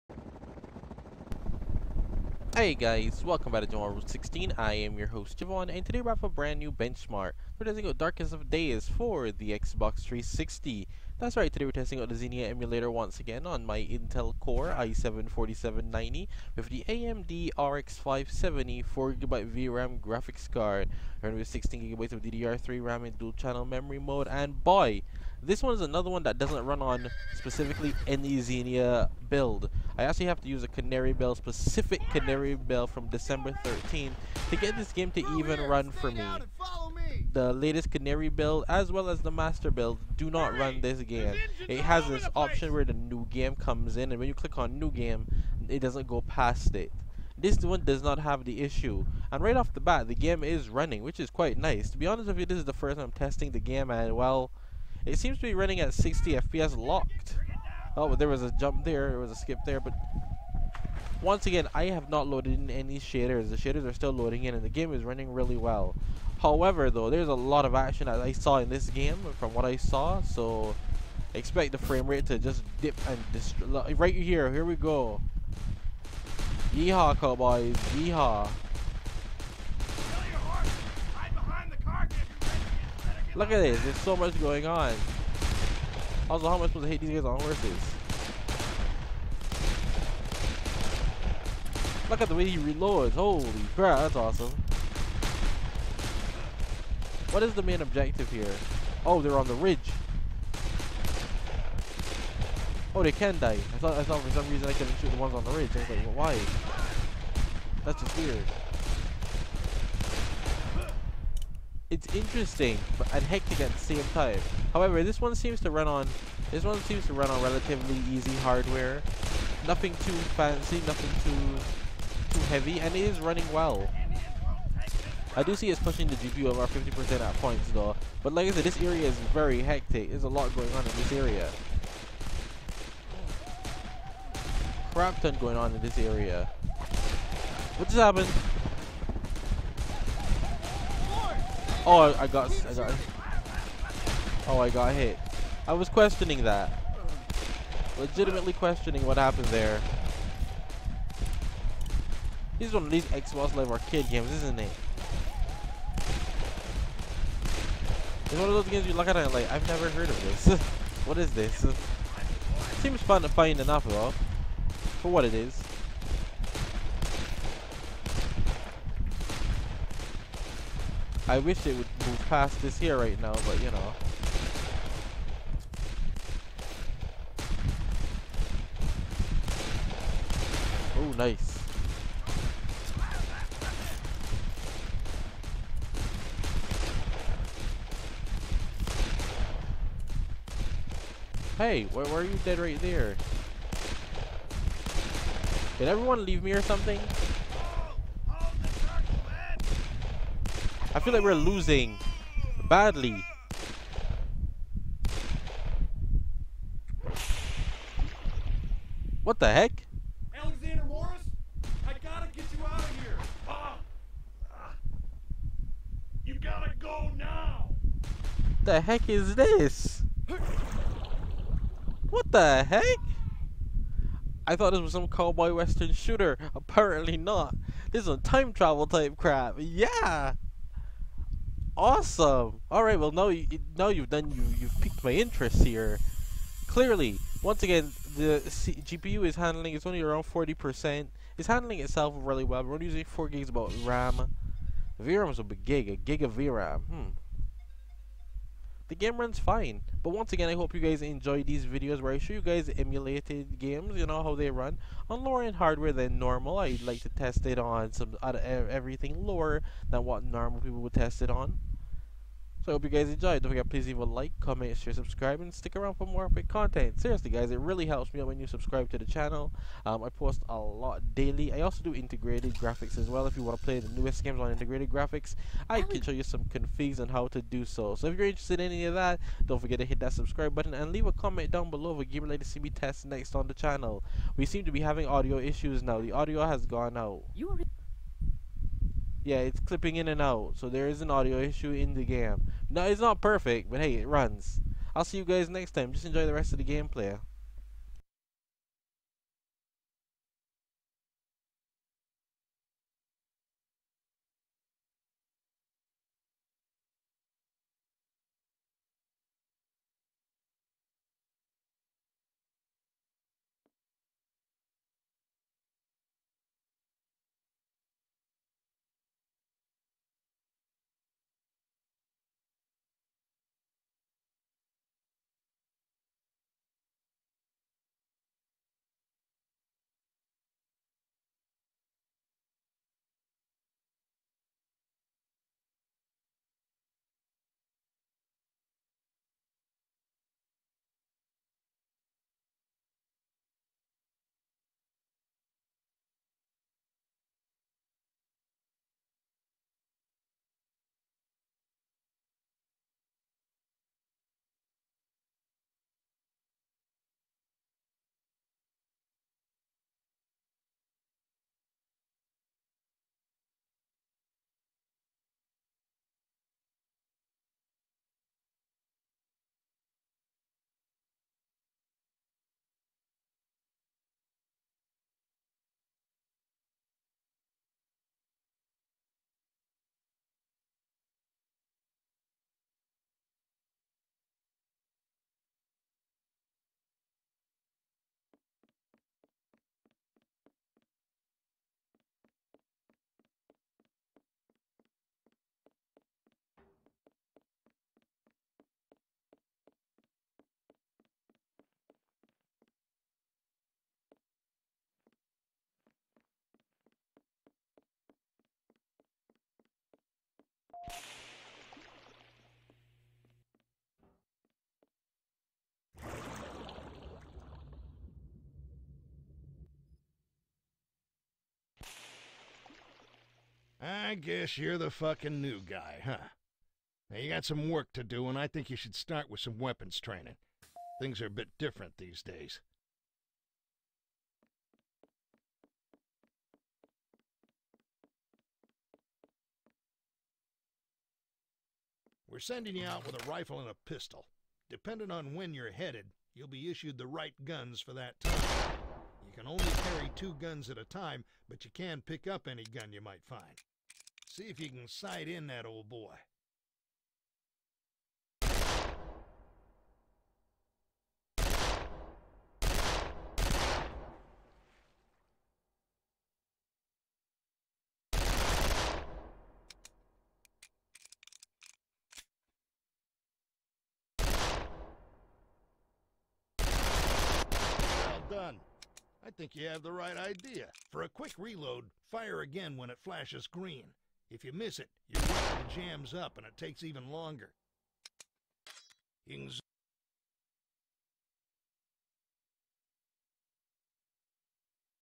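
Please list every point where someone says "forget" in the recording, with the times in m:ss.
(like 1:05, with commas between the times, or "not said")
4:23, 4:39.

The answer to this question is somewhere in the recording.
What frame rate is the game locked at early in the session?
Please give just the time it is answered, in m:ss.
0:55.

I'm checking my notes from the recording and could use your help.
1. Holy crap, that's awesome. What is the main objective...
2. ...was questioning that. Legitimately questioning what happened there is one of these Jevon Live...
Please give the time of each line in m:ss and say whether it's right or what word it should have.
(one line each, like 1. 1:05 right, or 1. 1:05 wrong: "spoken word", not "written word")
1. 1:33 right
2. 2:25 wrong: "Xbox", not "Jevon".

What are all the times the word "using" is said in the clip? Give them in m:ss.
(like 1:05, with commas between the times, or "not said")
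4:02.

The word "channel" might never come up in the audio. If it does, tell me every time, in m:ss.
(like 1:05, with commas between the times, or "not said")
0:23, 4:29, 4:43.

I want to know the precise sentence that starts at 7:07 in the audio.
Now, you got some work to do, and I think you should start with some weapons training.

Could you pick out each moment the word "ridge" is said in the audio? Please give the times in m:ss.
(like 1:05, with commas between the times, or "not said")
1:39, 1:45.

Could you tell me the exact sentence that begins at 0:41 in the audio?
It has this option where the new game comes in and when you click on new game, it doesn't go past it.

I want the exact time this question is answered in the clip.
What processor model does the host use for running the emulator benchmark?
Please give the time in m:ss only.
0:13.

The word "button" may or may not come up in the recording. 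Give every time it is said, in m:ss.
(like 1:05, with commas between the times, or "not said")
4:40.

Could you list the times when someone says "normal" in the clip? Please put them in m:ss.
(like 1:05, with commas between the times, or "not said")
4:16, 4:20.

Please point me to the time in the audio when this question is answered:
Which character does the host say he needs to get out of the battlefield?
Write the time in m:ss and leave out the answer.
3:30.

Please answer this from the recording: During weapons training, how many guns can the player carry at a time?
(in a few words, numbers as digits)
2.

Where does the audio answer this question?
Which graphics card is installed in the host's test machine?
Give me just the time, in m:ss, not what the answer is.
0:16.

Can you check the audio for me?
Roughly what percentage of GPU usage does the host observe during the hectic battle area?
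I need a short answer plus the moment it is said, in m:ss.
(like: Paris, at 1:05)
50%, at 2:06.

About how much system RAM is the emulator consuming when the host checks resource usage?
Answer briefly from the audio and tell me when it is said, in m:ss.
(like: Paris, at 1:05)
4 gigs, at 4:03.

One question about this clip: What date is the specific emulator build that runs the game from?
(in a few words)
December 13.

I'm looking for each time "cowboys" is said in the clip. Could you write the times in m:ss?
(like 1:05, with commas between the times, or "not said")
1:17, 3:45.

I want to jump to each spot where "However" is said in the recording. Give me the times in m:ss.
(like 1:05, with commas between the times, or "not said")
1:06, 1:54.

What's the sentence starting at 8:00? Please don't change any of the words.
For a quick reload, fire again when it flashes green.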